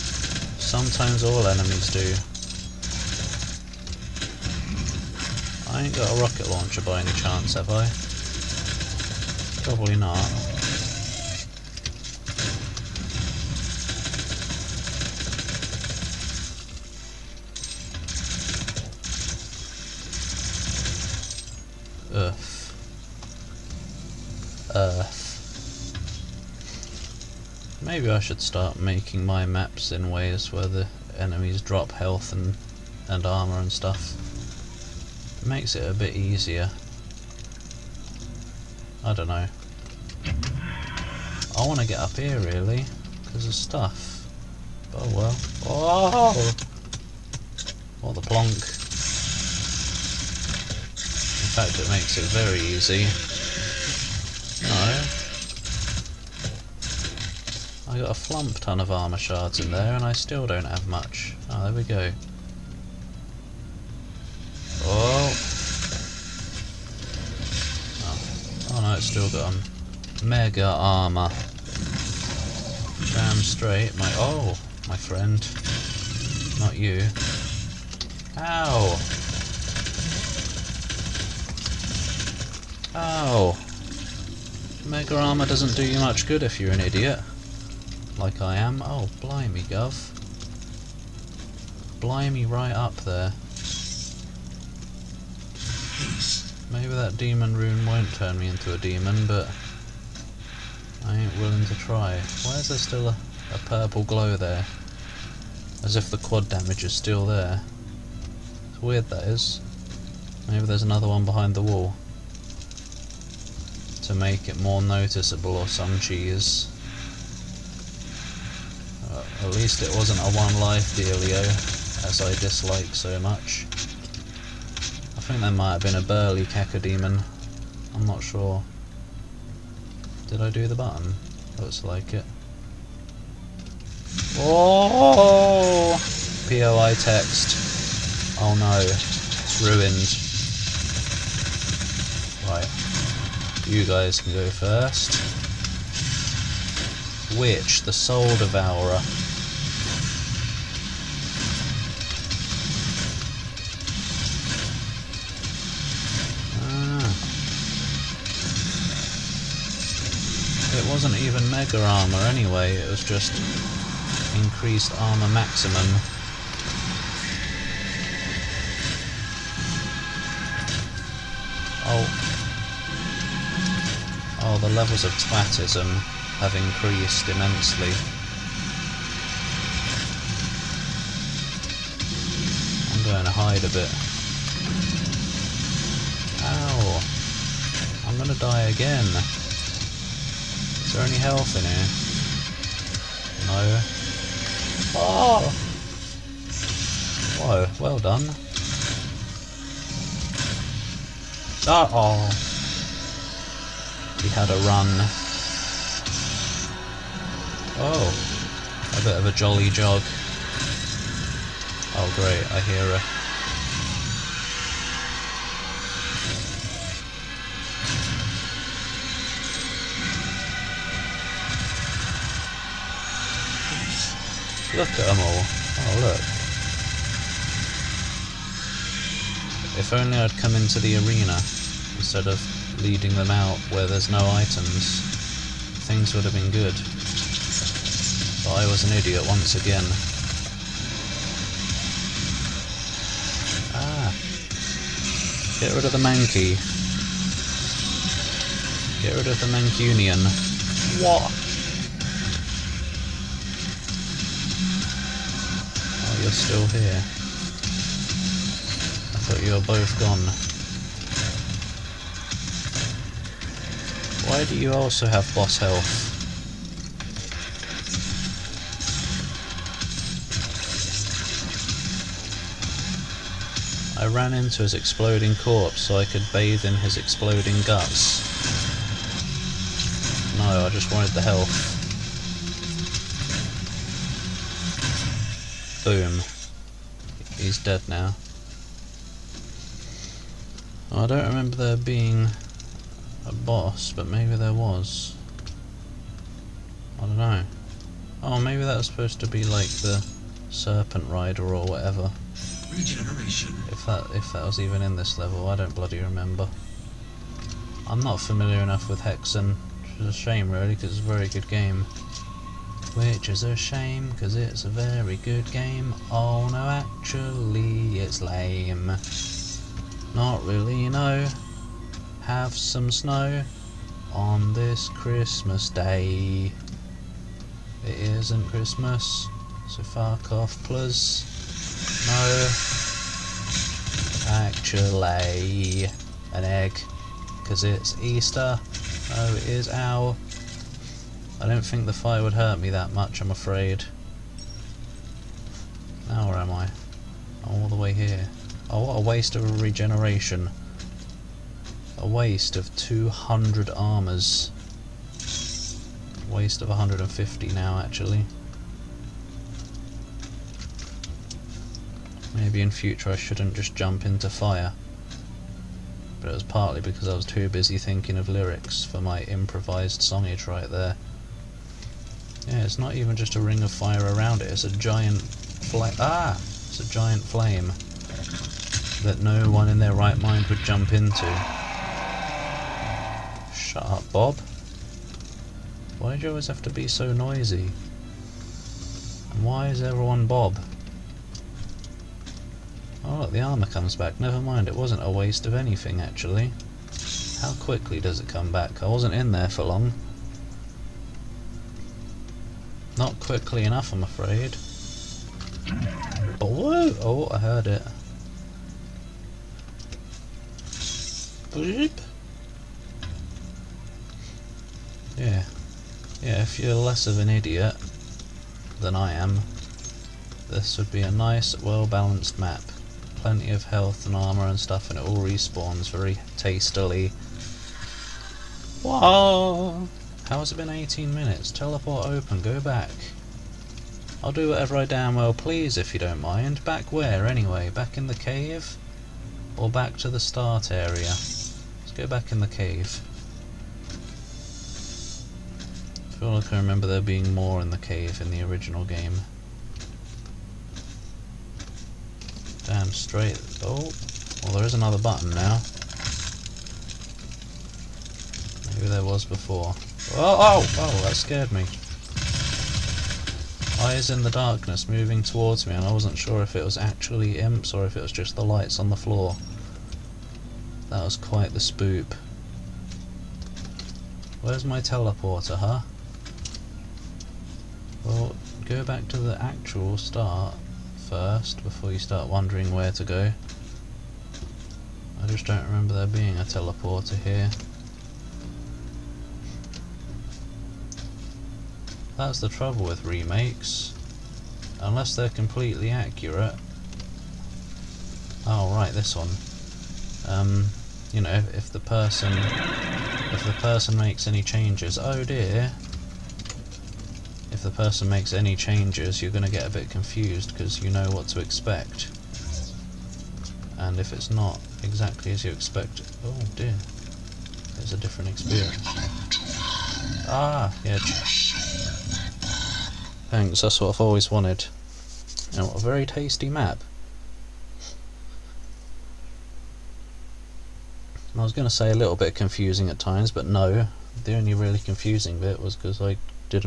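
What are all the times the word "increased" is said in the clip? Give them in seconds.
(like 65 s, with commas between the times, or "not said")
164 s, 176 s.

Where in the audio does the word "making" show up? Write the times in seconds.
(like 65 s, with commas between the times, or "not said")
28 s.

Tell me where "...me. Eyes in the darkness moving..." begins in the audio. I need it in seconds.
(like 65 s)
461 s.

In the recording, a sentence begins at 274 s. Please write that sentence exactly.
I ran into his exploding corpse so I could bathe in his exploding guts.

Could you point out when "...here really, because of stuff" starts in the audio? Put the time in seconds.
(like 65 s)
42 s.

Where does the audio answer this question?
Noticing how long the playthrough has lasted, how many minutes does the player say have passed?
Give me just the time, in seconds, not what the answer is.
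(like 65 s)
430 s.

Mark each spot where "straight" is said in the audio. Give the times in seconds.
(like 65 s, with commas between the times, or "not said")
73 s, 452 s.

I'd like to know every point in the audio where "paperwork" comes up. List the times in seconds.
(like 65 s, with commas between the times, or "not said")
not said.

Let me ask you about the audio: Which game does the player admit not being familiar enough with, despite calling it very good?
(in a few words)
Hexen.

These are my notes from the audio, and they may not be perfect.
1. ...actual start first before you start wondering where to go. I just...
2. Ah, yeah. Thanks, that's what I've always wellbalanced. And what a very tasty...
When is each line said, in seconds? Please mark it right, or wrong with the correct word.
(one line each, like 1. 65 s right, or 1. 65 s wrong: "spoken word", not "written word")
1. 479 s right
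2. 520 s wrong: "wanted", not "wellbalanced".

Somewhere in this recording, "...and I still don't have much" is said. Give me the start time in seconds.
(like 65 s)
59 s.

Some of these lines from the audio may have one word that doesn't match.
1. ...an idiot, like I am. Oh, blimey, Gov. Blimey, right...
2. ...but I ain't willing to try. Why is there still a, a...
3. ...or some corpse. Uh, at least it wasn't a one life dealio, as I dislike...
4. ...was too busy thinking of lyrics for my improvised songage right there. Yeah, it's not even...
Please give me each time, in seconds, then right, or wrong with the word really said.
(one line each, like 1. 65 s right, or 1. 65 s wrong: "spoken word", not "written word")
1. 86 s right
2. 99 s right
3. 115 s wrong: "cheese", not "corpse"
4. 367 s right.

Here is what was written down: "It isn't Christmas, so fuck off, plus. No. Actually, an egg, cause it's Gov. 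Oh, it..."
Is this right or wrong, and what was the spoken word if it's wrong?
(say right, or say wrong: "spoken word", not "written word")
wrong: "Easter", not "Gov".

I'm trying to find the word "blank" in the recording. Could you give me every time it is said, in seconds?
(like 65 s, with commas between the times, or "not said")
not said.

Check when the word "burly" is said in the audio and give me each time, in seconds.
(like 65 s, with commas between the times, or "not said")
126 s.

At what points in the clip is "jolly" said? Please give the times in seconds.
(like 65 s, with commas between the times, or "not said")
209 s.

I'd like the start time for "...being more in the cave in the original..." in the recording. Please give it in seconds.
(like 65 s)
447 s.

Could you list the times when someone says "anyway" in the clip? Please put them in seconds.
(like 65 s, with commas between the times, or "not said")
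162 s, 437 s.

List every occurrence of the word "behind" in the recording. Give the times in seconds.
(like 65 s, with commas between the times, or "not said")
111 s.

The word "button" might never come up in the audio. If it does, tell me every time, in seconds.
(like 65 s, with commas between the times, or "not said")
130 s, 454 s.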